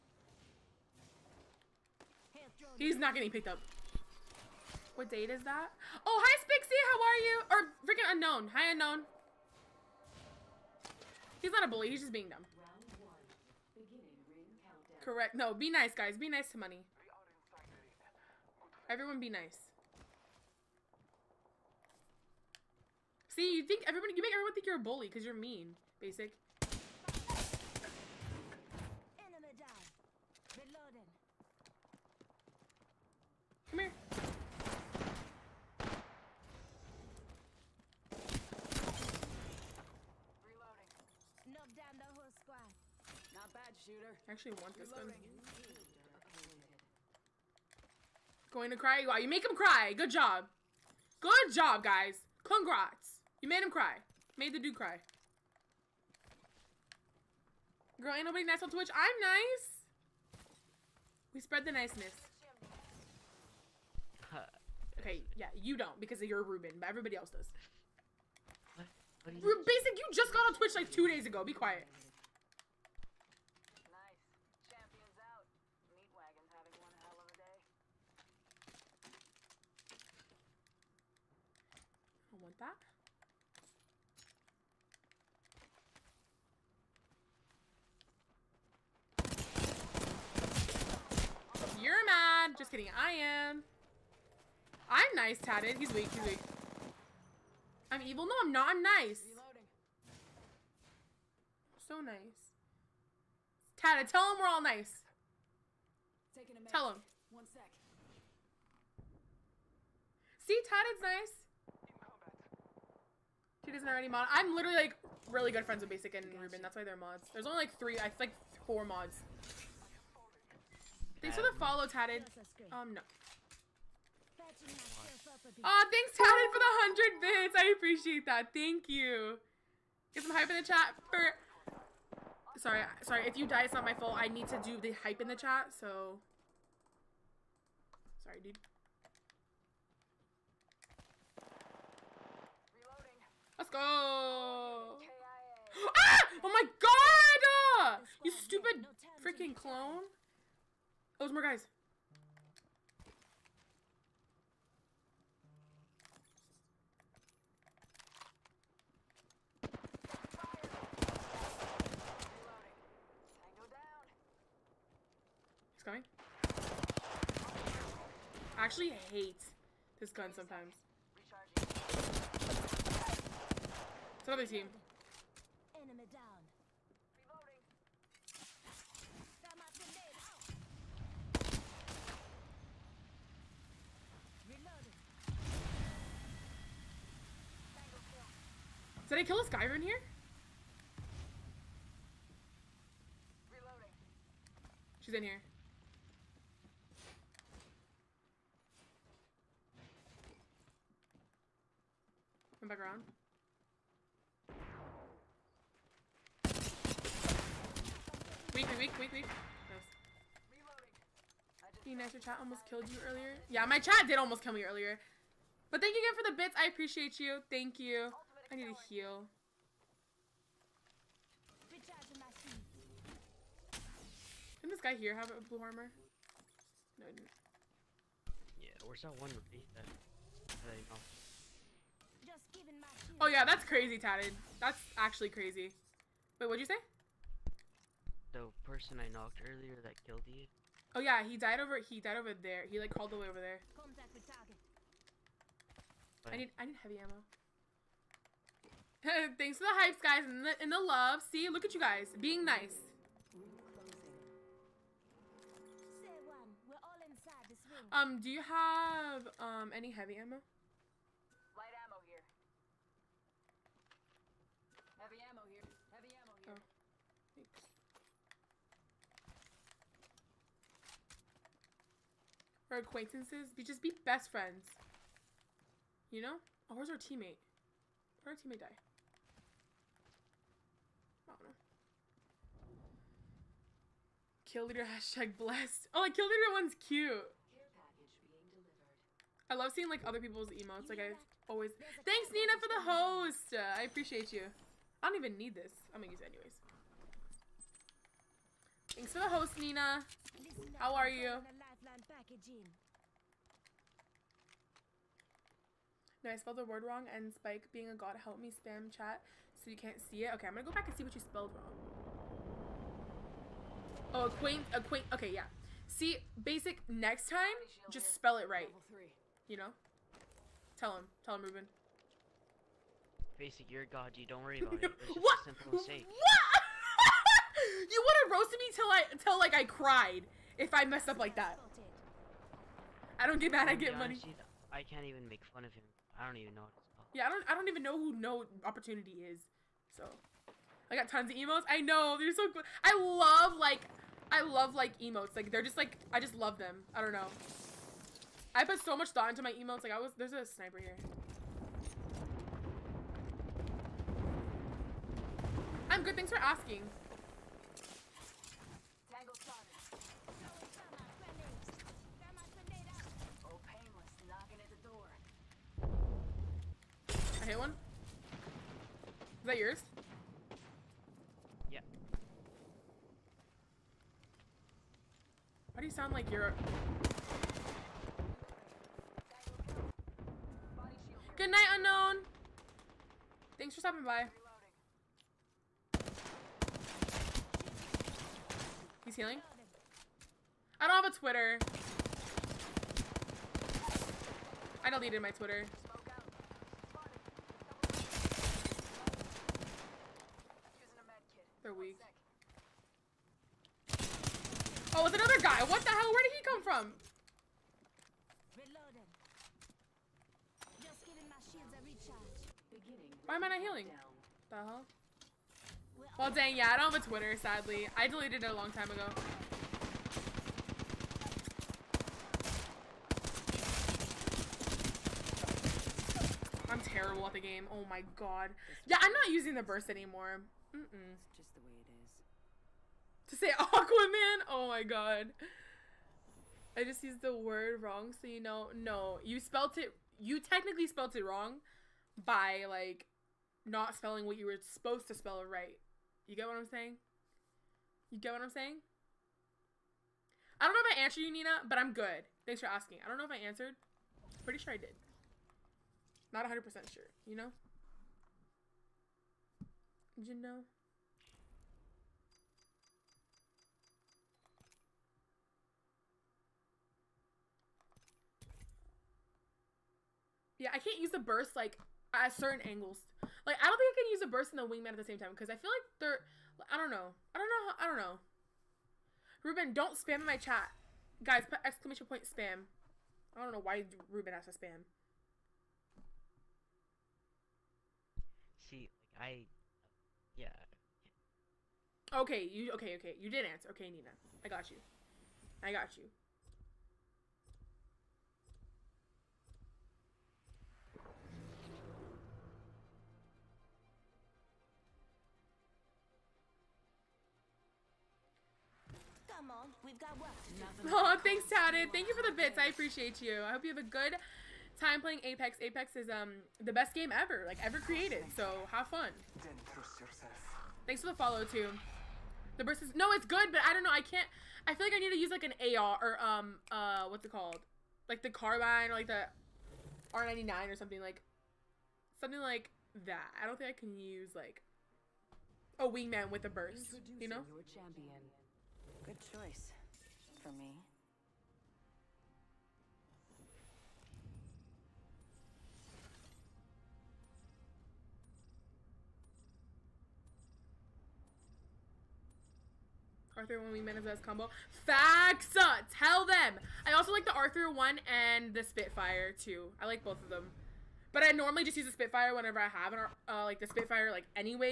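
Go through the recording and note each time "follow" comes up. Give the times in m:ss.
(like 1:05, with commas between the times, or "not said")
2:01, 8:41.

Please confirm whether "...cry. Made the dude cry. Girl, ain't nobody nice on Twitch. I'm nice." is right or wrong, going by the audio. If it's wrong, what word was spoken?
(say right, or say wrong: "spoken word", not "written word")
right.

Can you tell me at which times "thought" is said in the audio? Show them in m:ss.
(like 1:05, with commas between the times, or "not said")
5:49.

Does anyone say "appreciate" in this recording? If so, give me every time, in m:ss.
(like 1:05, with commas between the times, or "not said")
2:07, 3:36, 4:53, 8:32.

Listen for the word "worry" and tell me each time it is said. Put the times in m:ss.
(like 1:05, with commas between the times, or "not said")
5:24.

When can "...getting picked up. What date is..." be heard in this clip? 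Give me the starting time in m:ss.
0:03.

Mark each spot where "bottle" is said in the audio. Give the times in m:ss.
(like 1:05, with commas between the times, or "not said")
not said.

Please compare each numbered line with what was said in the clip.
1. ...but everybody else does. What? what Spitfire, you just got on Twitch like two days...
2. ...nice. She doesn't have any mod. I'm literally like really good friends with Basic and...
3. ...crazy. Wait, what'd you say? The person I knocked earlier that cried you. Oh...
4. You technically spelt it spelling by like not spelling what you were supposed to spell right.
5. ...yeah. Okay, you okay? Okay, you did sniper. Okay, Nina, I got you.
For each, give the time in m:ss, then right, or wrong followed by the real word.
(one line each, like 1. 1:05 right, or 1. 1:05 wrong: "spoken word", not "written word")
1. 1:06 wrong: "Basic", not "Spitfire"
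2. 1:51 right
3. 3:55 wrong: "killed", not "cried"
4. 7:20 wrong: "wrong", not "spelling"
5. 8:10 wrong: "answer", not "sniper".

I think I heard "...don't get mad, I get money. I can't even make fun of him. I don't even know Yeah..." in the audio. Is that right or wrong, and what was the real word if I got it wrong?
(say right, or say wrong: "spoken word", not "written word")
right.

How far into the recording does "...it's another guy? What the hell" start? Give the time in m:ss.
6:45.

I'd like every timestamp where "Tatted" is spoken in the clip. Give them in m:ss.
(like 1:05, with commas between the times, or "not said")
1:35, 1:43, 1:50, 2:01, 2:06, 3:53, 8:31.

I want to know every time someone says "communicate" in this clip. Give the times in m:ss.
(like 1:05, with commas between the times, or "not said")
not said.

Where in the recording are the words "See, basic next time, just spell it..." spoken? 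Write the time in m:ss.
5:15.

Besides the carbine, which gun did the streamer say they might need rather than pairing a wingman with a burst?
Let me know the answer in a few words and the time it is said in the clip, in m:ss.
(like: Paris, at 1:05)
R99, at 8:50.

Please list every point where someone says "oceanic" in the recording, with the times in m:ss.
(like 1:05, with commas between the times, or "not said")
not said.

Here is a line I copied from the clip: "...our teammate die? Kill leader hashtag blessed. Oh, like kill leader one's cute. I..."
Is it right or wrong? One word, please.
right.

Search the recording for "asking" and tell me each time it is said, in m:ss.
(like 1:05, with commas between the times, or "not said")
5:56, 7:32.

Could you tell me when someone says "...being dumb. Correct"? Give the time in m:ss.
0:12.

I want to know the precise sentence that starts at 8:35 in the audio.
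Apex is um the best game ever, like ever created.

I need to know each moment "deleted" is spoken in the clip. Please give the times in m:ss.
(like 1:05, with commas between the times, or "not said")
6:34, 6:58.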